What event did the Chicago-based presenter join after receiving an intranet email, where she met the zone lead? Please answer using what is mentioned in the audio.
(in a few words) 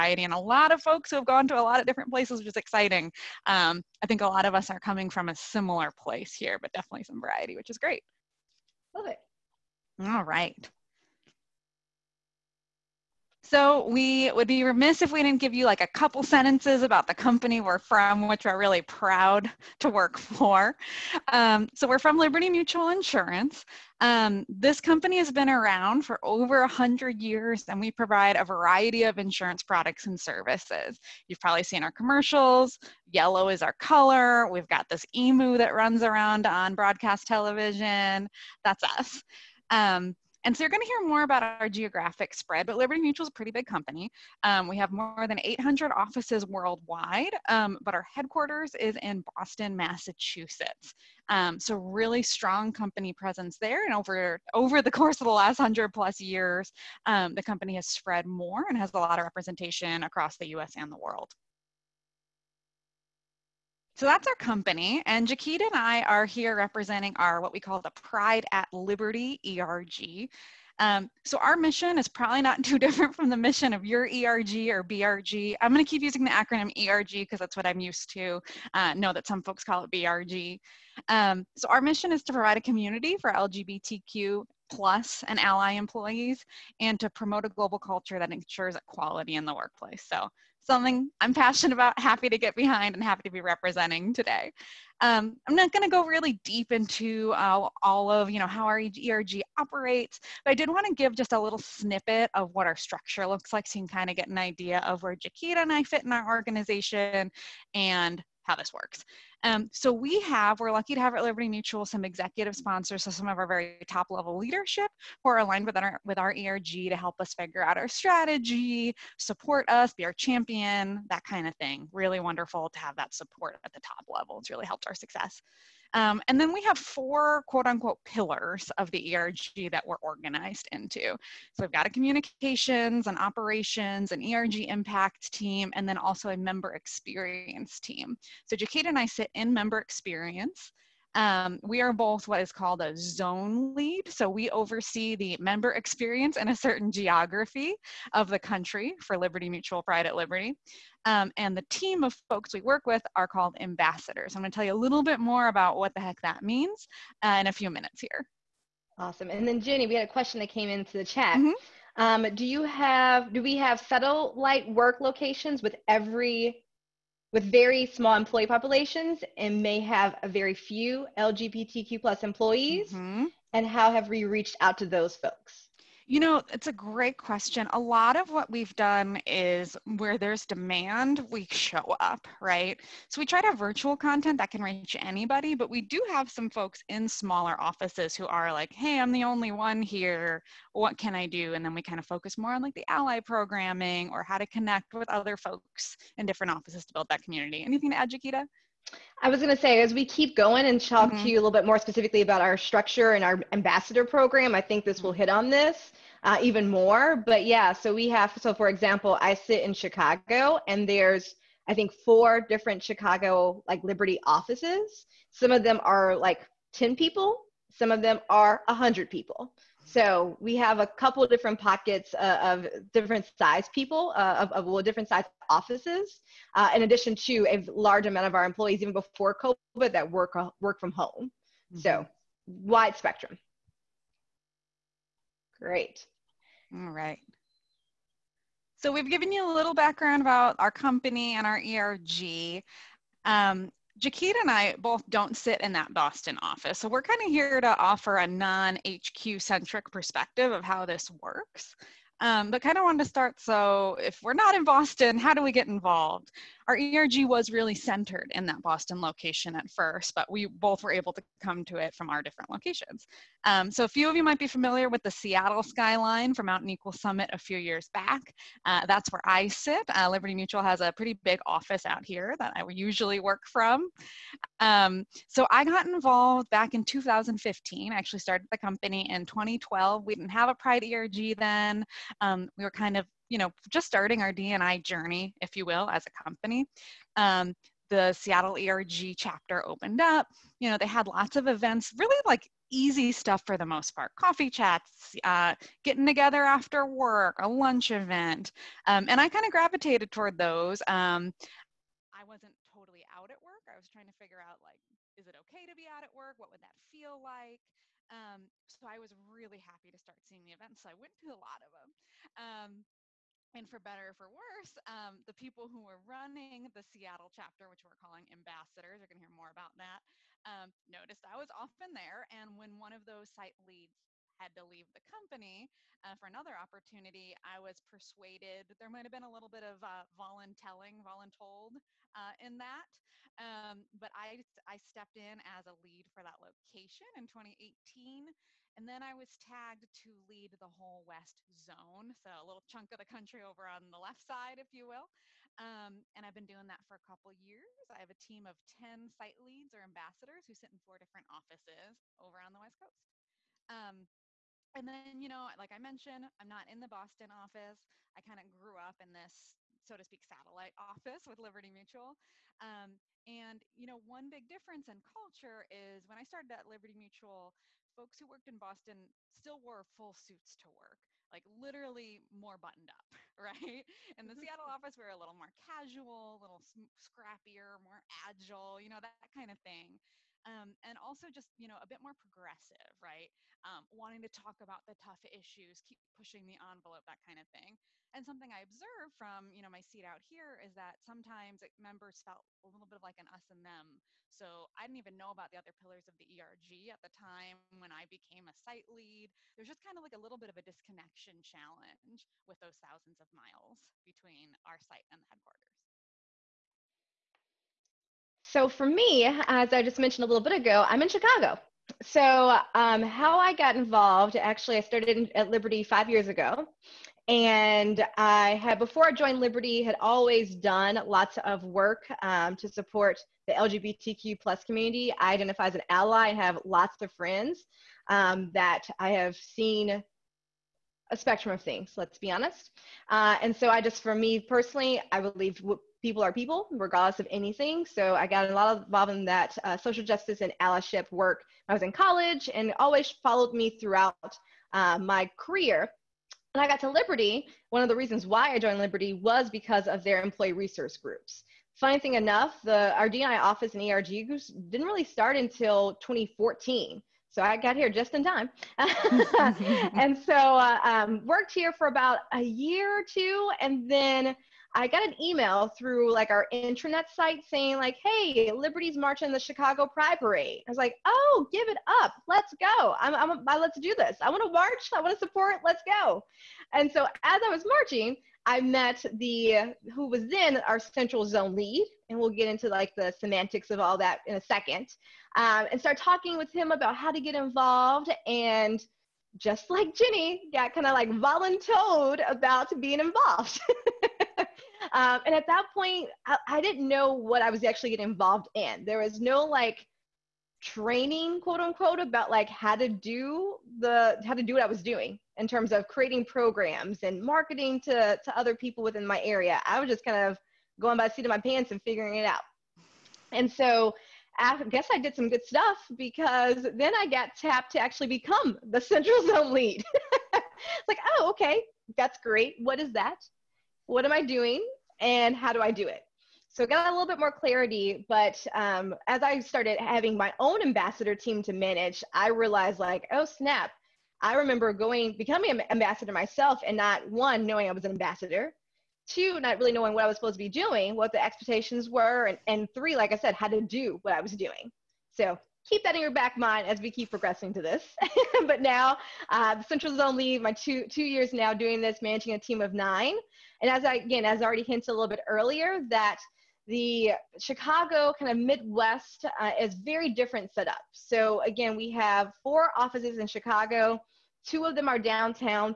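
Chicago Pride Parade.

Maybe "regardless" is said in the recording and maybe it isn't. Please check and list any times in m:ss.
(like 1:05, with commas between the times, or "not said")
7:16.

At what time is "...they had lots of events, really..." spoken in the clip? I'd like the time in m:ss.
4:50.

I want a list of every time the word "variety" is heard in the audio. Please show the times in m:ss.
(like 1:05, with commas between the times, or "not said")
0:07, 0:28.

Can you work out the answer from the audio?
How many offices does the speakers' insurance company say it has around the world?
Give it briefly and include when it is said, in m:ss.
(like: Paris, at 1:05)
More than 800, at 0:44.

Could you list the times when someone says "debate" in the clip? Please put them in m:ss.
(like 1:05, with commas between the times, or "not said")
not said.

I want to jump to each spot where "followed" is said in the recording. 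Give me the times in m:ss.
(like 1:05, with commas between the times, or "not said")
7:23.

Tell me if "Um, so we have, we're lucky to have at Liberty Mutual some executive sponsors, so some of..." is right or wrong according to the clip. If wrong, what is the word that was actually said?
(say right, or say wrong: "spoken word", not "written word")
right.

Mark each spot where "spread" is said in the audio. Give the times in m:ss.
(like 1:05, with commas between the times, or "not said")
0:42, 0:57.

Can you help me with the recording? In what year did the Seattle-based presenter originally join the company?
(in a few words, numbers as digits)
2012.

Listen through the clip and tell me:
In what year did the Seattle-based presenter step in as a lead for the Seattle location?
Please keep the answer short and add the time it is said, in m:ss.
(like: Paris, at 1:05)
2018, at 5:37.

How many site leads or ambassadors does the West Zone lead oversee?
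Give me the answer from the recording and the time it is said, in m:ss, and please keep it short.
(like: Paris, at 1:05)
10, at 5:48.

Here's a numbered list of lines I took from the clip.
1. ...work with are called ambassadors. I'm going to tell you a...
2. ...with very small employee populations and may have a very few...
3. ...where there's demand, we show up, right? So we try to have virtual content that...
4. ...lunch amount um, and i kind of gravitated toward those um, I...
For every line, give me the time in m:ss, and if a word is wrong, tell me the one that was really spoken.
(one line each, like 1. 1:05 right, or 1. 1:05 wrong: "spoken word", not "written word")
1. 2:32 right
2. 2:47 right
3. 2:59 right
4. 4:57 wrong: "event", not "amount".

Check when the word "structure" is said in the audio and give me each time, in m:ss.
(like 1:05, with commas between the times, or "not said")
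1:42, 3:22.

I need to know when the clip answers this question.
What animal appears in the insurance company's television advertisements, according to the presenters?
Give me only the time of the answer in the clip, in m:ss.
0:35.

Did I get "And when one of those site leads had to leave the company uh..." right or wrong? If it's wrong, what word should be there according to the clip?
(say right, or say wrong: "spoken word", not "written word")
right.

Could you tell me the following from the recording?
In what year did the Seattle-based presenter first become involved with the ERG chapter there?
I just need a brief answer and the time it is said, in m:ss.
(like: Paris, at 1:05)
2015, at 4:36.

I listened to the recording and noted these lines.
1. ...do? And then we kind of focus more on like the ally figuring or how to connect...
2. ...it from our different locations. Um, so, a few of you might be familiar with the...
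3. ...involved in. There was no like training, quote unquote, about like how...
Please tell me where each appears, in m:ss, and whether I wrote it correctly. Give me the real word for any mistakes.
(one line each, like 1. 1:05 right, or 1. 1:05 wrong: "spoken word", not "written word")
1. 3:11 wrong: "programming", not "figuring"
2. 4:21 right
3. 8:18 right.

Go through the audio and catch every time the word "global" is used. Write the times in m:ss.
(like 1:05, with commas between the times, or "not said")
1:27.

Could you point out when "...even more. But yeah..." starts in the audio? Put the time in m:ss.
3:26.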